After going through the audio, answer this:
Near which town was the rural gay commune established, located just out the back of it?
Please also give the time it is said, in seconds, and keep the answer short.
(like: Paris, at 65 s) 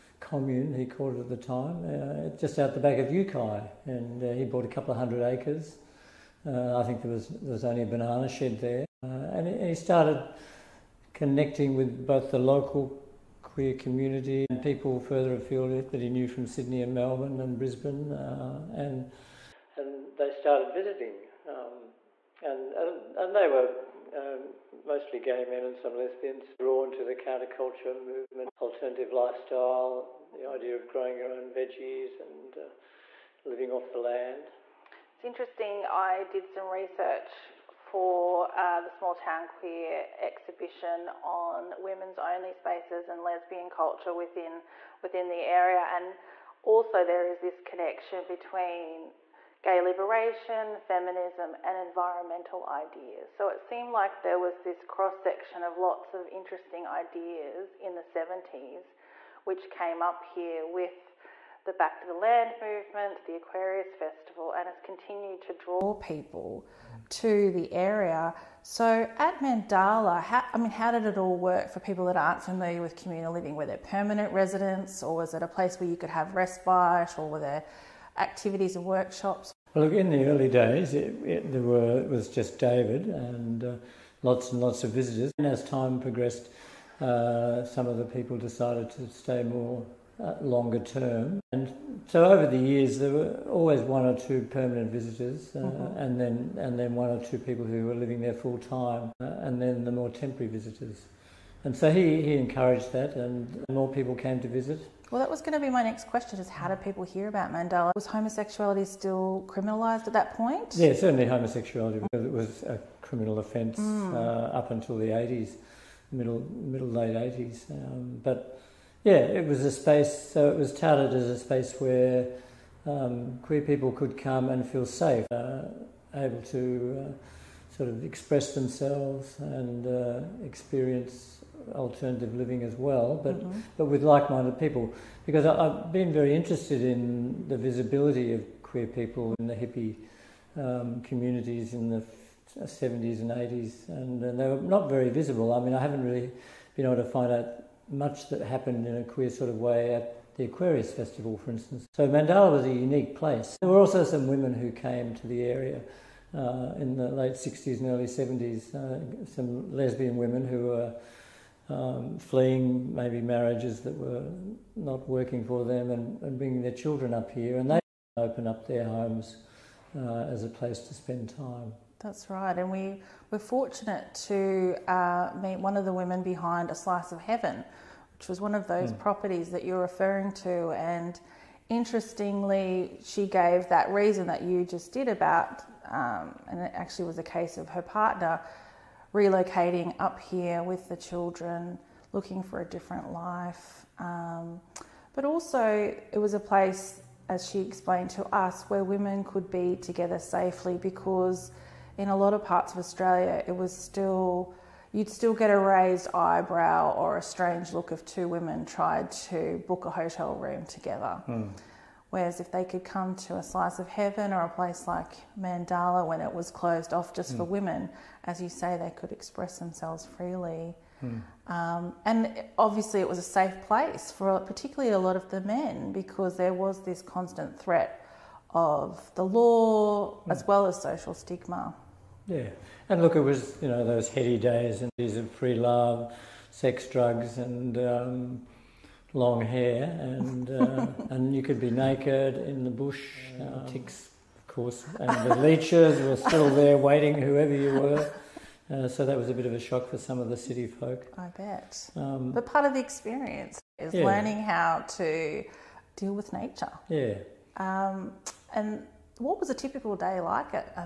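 Uki, at 3 s.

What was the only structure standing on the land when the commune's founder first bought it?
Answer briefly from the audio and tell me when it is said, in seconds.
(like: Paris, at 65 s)
A banana shed, at 7 s.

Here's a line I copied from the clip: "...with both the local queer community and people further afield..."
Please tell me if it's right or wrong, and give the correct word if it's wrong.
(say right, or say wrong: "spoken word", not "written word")
right.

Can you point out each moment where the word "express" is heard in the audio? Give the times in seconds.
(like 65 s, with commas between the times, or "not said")
128 s, 219 s.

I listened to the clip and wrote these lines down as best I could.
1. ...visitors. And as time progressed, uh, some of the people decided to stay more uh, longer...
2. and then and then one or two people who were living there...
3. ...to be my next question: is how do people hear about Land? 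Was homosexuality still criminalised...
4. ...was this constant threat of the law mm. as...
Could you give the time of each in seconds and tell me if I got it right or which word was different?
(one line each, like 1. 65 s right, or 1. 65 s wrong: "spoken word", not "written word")
1. 84 s right
2. 95 s right
3. 105 s wrong: "Mandala", not "Land"
4. 226 s right.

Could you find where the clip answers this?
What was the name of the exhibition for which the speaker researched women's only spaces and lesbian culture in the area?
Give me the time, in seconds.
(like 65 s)
38 s.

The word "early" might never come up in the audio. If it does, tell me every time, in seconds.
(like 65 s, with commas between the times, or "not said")
80 s, 157 s.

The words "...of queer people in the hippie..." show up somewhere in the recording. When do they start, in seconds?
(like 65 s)
138 s.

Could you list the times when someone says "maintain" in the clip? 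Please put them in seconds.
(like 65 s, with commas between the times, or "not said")
not said.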